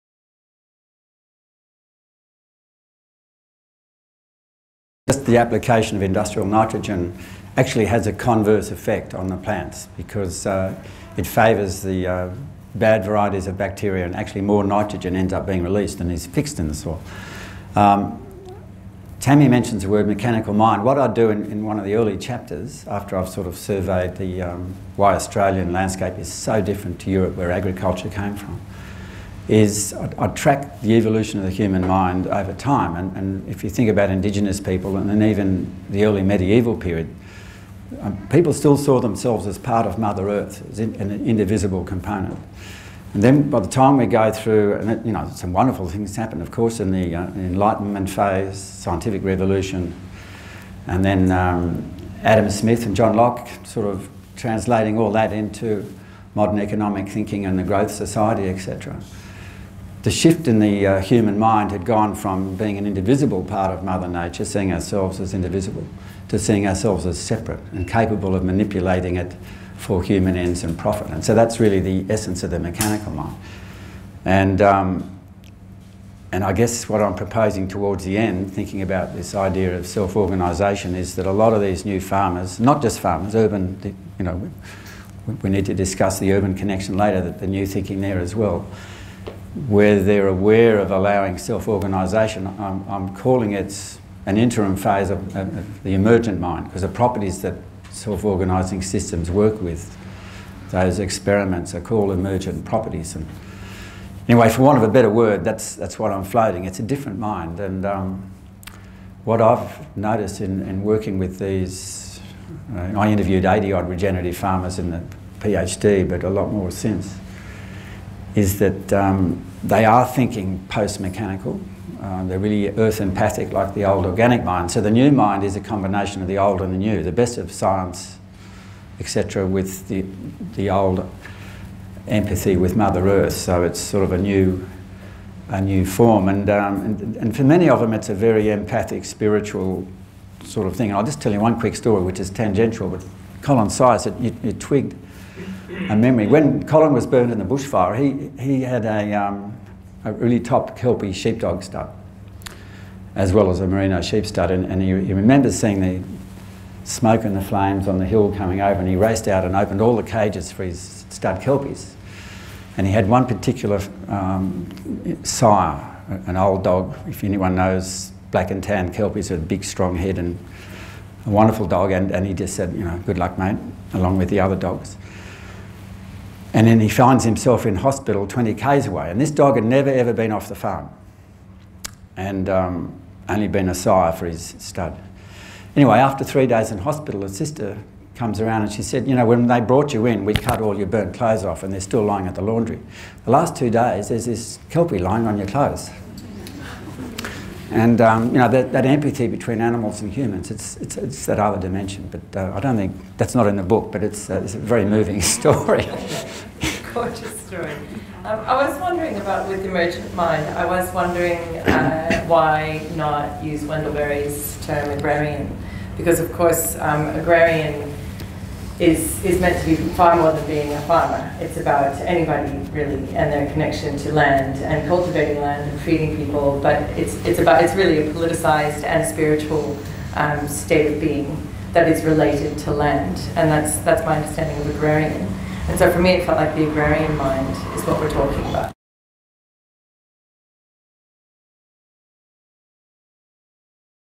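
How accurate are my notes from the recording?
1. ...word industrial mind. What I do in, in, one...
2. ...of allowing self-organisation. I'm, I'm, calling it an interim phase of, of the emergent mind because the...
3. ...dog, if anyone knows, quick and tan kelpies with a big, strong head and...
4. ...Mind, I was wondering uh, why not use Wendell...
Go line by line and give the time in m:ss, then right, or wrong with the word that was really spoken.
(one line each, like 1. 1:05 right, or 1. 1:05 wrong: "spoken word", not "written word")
1. 0:19 wrong: "mechanical", not "industrial"
2. 1:30 right
3. 2:46 wrong: "black", not "quick"
4. 3:30 right.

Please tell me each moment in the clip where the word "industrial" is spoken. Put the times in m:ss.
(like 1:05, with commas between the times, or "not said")
0:06.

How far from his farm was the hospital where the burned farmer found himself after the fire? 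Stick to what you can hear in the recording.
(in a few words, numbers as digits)
20 km.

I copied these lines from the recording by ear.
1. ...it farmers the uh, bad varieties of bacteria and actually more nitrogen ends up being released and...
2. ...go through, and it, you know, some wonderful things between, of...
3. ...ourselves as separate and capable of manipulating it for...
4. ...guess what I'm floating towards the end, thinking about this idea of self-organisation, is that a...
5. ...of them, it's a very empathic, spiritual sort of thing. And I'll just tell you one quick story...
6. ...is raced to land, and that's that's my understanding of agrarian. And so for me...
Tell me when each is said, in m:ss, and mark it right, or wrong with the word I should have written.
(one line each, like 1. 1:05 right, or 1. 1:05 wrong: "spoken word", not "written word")
1. 0:11 wrong: "favours", not "farmers"
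2. 0:44 wrong: "happen", not "between"
3. 1:06 right
4. 1:16 wrong: "proposing", not "floating"
5. 2:17 right
6. 3:51 wrong: "related", not "raced".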